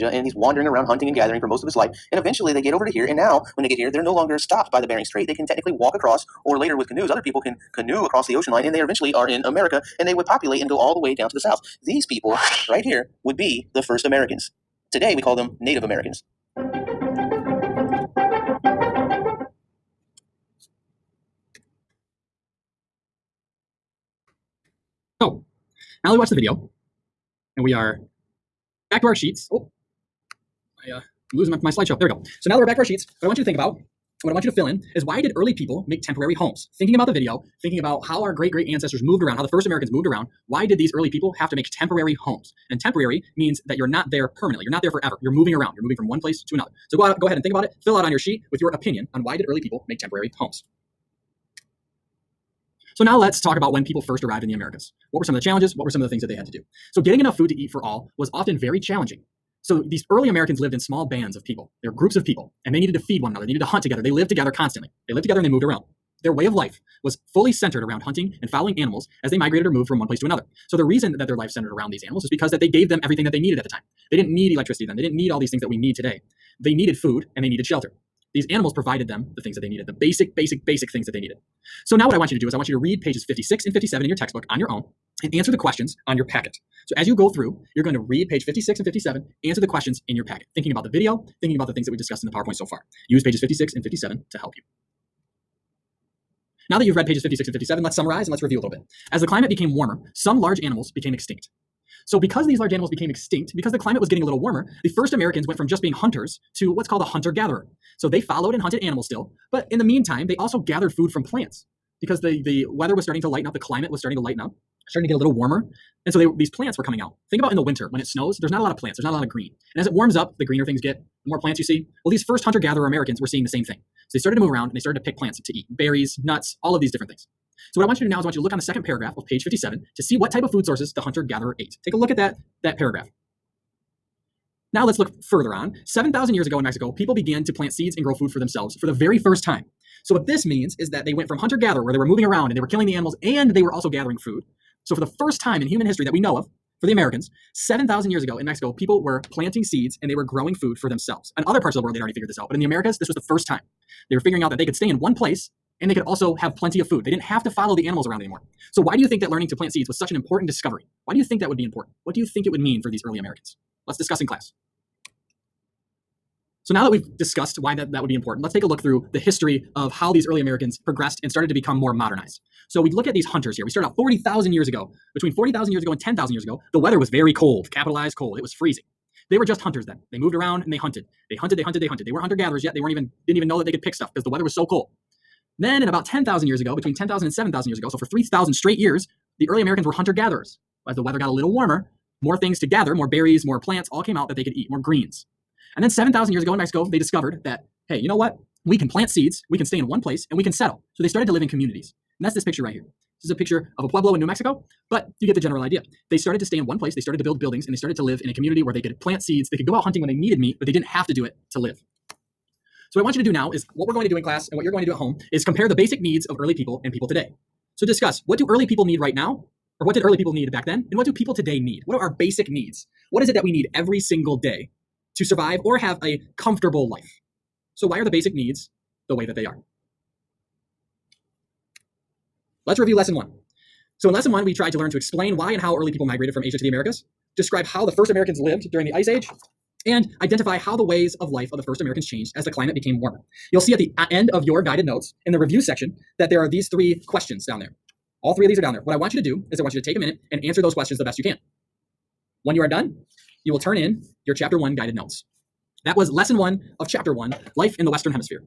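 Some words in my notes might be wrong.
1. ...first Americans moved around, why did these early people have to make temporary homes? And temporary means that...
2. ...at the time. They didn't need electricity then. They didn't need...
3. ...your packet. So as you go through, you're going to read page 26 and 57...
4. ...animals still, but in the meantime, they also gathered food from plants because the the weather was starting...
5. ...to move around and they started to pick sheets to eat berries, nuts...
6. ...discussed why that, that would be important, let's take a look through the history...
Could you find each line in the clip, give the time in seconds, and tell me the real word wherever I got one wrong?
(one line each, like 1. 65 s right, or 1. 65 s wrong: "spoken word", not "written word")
1. 39 s right
2. 73 s right
3. 86 s wrong: "56", not "26"
4. 108 s right
5. 124 s wrong: "plants", not "sheets"
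6. 167 s right.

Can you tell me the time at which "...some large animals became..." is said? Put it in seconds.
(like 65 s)
100 s.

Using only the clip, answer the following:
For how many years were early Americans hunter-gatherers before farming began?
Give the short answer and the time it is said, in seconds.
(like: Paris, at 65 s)
3,000, at 188 s.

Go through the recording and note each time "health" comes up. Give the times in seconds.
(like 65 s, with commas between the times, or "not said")
not said.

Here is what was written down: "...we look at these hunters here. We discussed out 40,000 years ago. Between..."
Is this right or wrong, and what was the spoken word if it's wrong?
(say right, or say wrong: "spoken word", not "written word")
wrong: "started", not "discussed".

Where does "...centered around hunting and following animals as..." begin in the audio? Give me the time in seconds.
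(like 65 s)
67 s.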